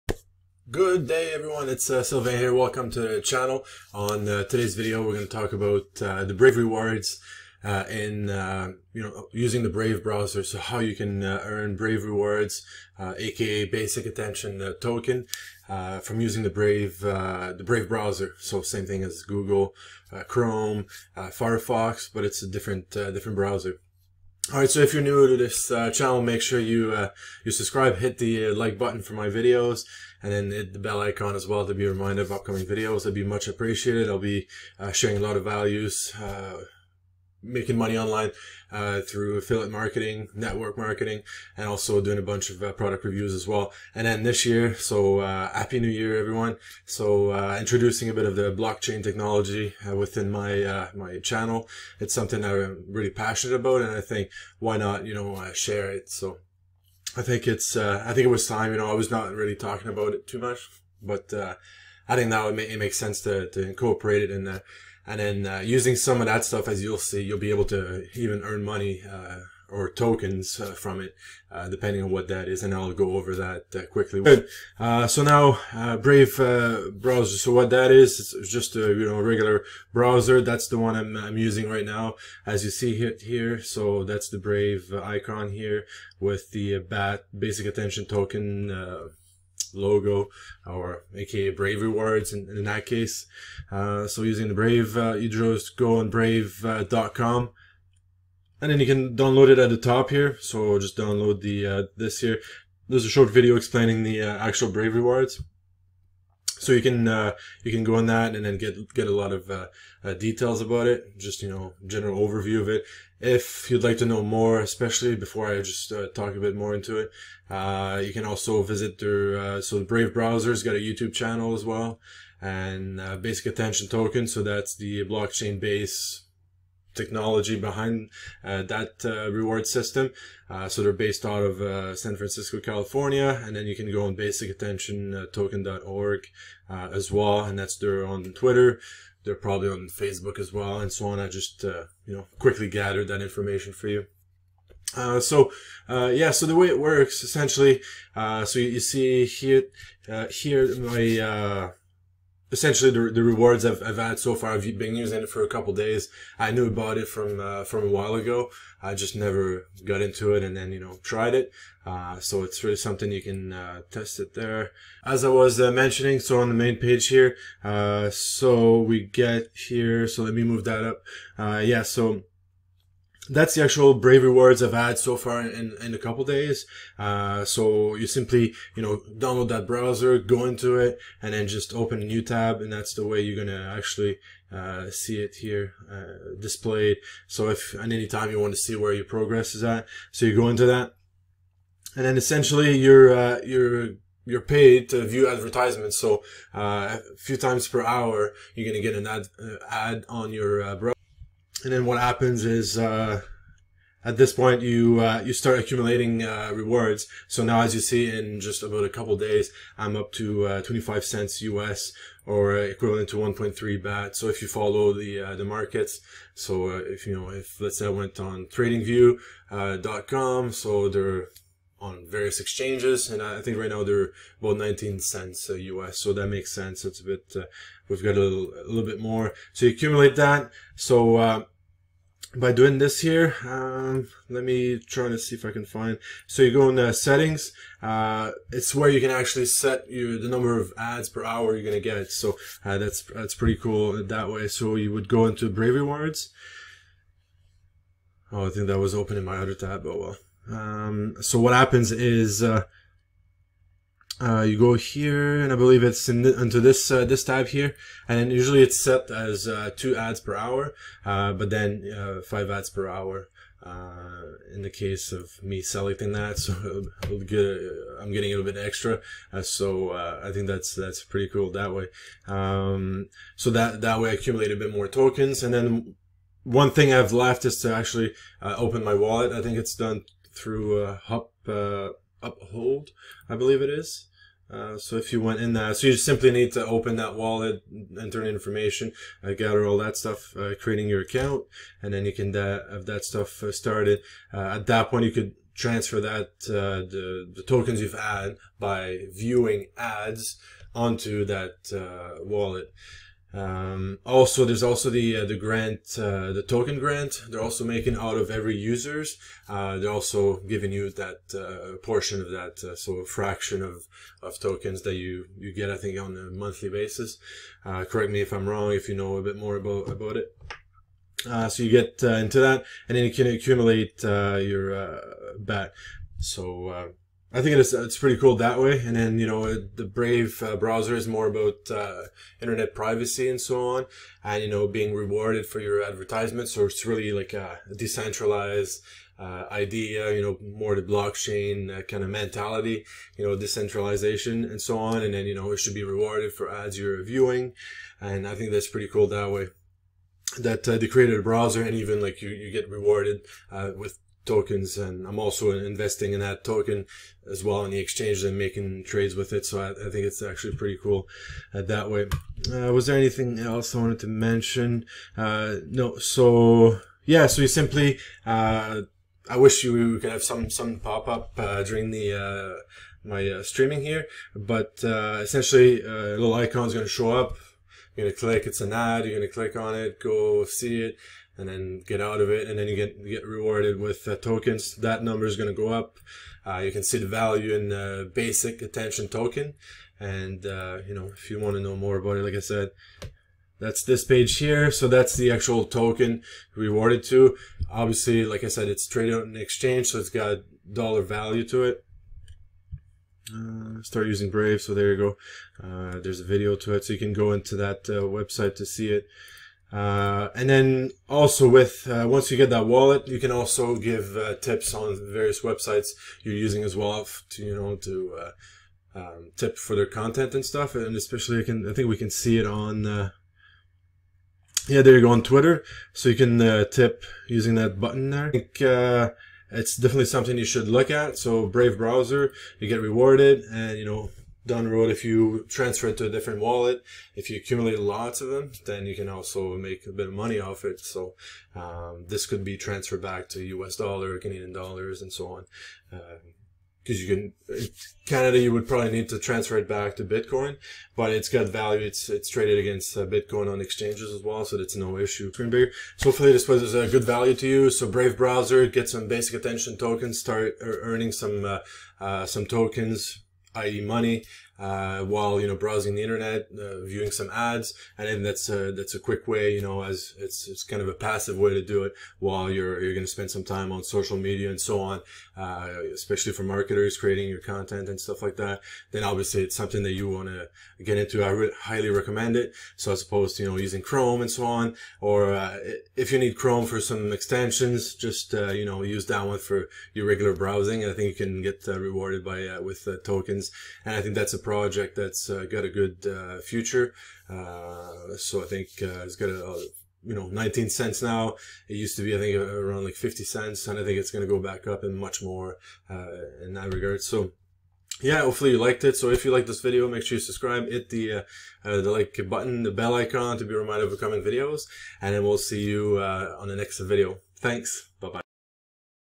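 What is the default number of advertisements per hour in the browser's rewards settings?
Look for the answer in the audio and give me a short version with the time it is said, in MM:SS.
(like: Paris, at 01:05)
2, at 04:19.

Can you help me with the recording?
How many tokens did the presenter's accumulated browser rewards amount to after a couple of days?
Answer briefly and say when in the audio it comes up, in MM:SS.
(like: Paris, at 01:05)
1.3 BAT, at 03:33.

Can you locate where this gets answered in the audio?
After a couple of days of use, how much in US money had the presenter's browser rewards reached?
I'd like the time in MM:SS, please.
03:30.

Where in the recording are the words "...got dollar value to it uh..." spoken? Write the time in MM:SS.
06:40.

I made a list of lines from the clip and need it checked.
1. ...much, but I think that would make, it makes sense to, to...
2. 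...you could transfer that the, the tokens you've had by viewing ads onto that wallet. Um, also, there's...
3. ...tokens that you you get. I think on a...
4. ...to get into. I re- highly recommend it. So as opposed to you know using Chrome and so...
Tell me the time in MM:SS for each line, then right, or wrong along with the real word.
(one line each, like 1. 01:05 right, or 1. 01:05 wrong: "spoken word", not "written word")
1. 01:00 right
2. 04:55 right
3. 05:14 right
4. 08:00 right.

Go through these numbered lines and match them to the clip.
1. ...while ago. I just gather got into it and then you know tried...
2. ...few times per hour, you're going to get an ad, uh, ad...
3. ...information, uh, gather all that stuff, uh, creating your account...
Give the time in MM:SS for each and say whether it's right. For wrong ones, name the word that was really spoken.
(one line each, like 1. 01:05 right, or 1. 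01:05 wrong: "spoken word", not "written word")
1. 02:37 wrong: "never", not "gather"
2. 03:17 right
3. 04:48 right.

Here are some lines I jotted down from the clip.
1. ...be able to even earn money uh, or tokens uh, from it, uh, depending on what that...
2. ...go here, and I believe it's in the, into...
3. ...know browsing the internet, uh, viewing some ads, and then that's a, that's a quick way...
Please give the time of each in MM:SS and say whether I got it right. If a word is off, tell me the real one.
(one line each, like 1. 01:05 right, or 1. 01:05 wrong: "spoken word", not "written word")
1. 01:07 right
2. 04:14 right
3. 07:45 right.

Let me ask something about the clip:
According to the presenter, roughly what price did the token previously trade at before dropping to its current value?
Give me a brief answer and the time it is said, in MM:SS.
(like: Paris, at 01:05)
50 cents, at 08:22.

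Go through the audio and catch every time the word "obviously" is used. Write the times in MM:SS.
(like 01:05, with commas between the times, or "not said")
06:37, 07:59.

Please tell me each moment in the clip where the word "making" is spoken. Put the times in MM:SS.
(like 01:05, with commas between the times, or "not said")
00:37, 05:07, 05:58.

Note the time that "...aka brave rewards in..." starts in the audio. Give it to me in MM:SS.
01:31.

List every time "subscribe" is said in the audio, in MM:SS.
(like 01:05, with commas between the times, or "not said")
00:27, 08:30.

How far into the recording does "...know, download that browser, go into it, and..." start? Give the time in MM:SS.
02:58.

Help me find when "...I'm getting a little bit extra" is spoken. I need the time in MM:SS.
04:28.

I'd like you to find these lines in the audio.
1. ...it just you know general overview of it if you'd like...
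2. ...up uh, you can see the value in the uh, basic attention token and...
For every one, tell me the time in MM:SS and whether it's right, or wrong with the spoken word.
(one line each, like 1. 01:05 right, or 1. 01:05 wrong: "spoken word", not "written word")
1. 01:50 right
2. 06:25 right.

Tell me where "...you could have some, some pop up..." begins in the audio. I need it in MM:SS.
06:09.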